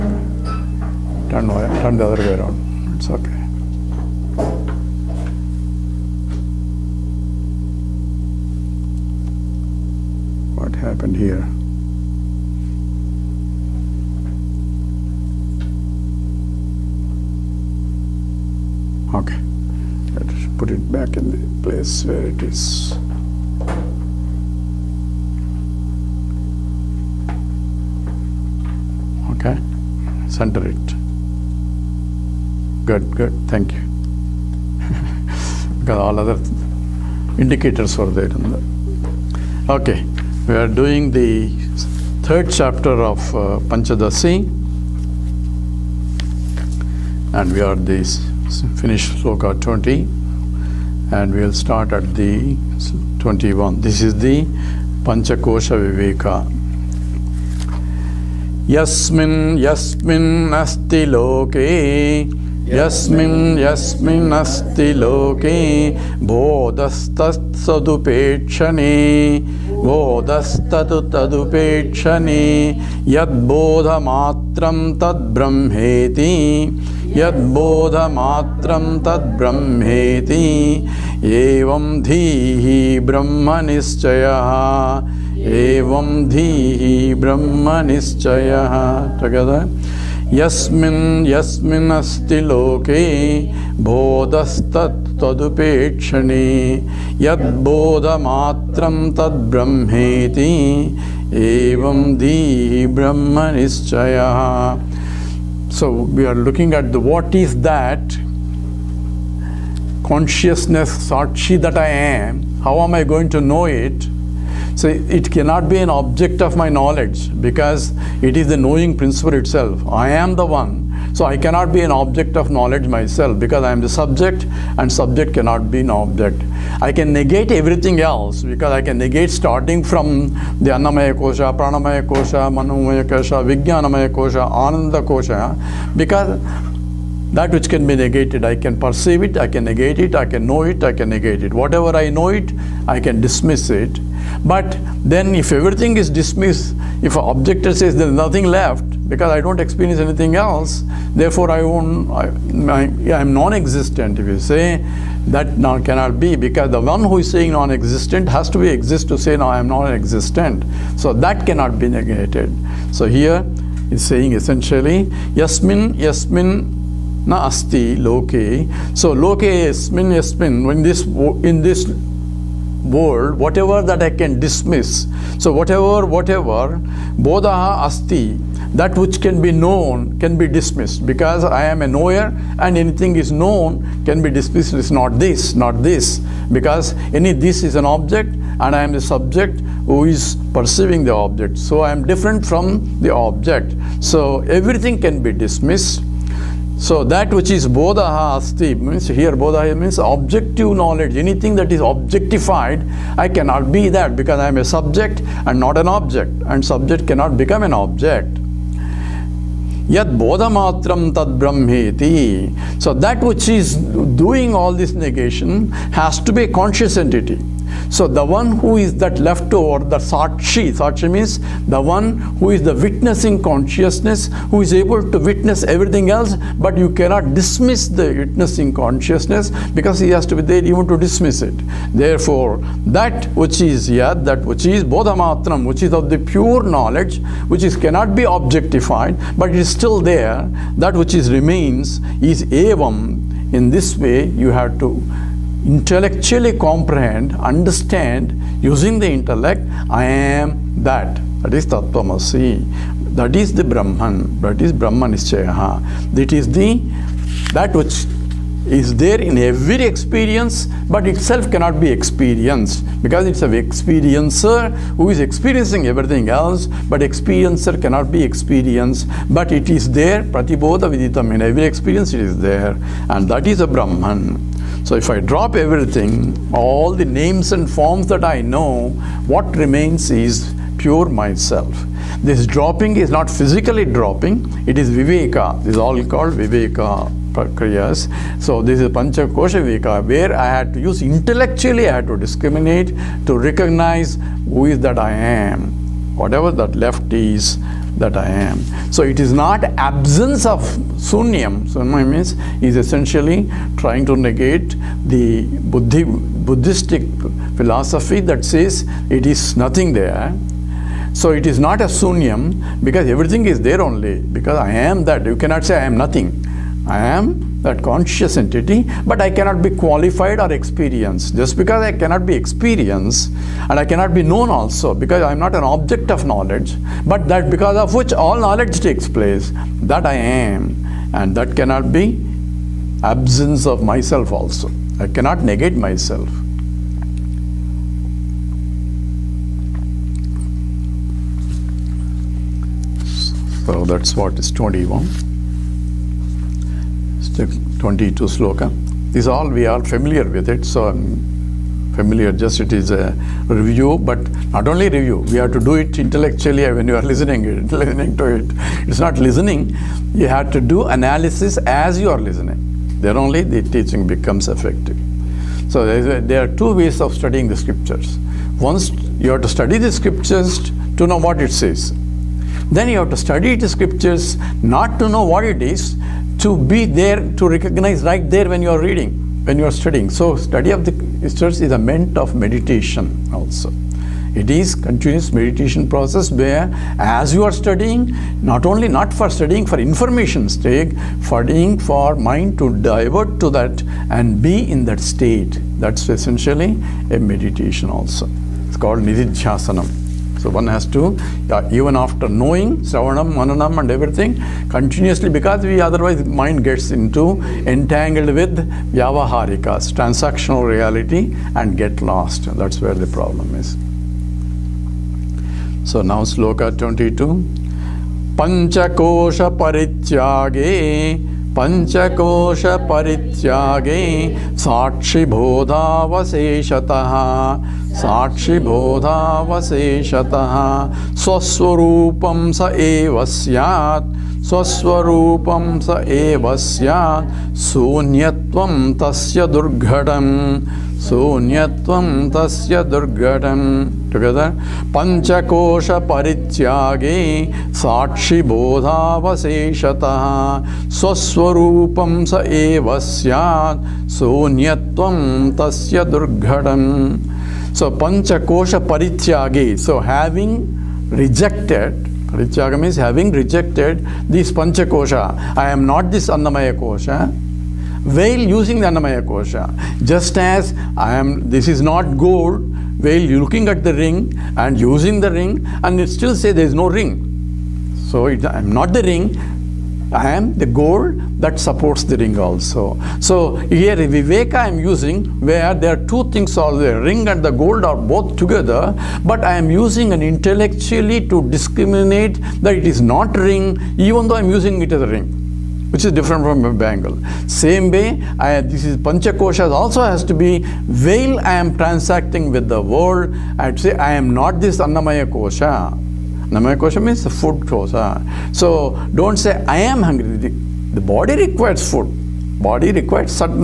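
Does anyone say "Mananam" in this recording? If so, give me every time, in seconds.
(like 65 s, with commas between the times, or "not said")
403 s.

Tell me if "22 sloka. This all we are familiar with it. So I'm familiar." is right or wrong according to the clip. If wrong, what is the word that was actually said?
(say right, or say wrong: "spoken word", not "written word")
right.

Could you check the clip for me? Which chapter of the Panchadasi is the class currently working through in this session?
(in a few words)
third.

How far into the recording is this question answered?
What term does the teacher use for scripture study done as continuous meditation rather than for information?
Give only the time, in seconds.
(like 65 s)
398 s.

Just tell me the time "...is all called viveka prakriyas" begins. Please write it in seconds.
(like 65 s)
285 s.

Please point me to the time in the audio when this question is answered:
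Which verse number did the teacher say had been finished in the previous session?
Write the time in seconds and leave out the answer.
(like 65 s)
49 s.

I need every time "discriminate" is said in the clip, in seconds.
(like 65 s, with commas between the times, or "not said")
292 s, 491 s.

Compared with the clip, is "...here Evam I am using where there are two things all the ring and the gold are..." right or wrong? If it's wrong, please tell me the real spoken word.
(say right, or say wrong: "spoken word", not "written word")
wrong: "Viveka", not "Evam".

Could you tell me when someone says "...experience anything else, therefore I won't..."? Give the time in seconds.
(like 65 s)
149 s.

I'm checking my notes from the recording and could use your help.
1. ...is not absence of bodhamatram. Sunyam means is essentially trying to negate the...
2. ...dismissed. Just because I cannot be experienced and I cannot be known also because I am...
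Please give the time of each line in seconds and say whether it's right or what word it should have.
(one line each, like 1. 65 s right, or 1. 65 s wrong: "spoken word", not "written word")
1. 299 s wrong: "sunyam", not "bodhamatram"
2. 320 s wrong: "experienced", not "dismissed".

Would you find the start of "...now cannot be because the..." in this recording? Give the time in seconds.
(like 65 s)
155 s.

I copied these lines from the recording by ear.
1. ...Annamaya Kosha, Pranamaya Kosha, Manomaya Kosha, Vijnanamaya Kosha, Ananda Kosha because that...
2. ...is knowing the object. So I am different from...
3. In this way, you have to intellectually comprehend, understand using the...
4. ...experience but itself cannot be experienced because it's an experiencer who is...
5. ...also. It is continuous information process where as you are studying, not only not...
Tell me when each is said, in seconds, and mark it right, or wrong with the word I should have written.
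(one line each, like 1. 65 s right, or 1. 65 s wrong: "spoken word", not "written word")
1. 130 s right
2. 190 s wrong: "perceiving", not "knowing"
3. 243 s right
4. 259 s right
5. 383 s wrong: "meditation", not "information".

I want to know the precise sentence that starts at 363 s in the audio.
Then only the teaching becomes effective.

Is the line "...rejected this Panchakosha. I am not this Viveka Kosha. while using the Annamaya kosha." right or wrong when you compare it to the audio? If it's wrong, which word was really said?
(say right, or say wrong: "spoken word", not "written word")
wrong: "Annamaya", not "Viveka".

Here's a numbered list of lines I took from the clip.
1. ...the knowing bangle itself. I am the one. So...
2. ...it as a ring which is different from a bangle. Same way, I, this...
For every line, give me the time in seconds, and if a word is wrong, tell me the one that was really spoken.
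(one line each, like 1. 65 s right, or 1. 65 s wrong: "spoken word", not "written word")
1. 118 s wrong: "principle", not "bangle"
2. 494 s right.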